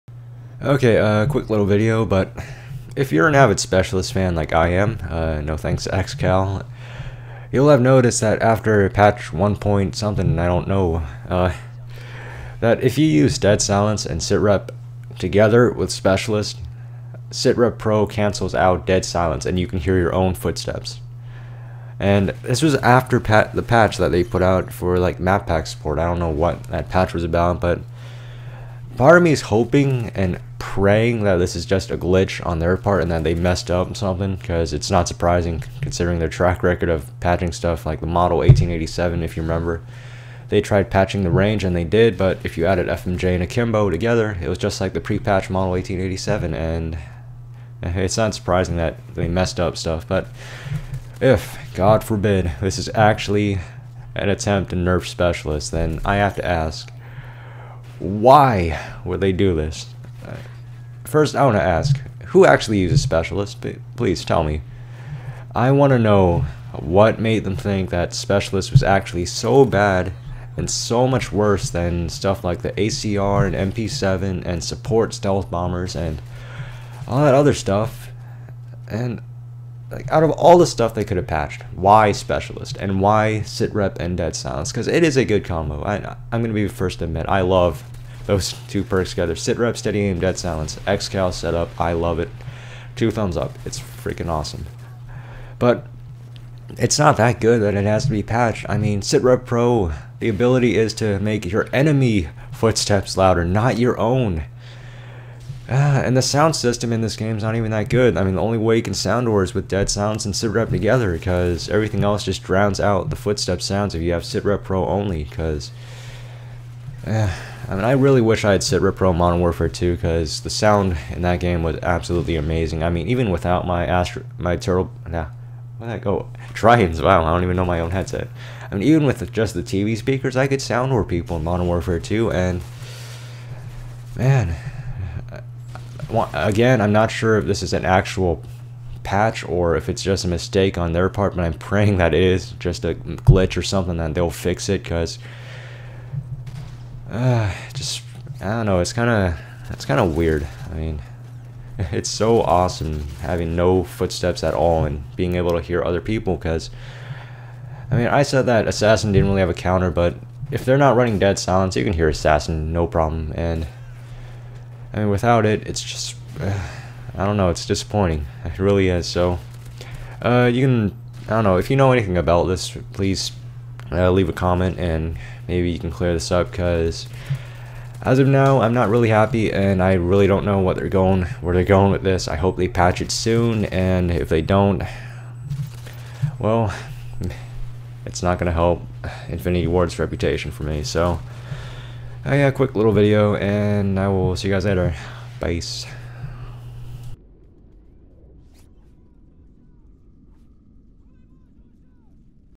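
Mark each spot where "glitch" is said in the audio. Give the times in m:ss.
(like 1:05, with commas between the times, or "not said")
0:31, 2:22.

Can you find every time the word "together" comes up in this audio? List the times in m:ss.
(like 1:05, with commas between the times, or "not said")
0:15, 0:43, 1:29, 1:50.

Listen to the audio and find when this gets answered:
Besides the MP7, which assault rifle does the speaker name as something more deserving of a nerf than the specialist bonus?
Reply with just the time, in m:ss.
1:12.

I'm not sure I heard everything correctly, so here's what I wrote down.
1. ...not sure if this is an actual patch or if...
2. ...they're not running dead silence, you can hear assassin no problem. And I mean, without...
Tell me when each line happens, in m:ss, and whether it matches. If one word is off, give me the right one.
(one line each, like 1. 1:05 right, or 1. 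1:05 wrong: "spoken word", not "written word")
1. 2:16 right
2. 2:40 right.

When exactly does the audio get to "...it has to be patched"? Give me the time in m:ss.
1:37.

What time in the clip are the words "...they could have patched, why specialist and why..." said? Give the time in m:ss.
1:20.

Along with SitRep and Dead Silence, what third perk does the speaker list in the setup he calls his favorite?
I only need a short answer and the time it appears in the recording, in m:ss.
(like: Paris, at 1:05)
Steady Aim, at 1:29.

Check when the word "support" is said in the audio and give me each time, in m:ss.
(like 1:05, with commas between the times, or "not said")
0:25, 1:14.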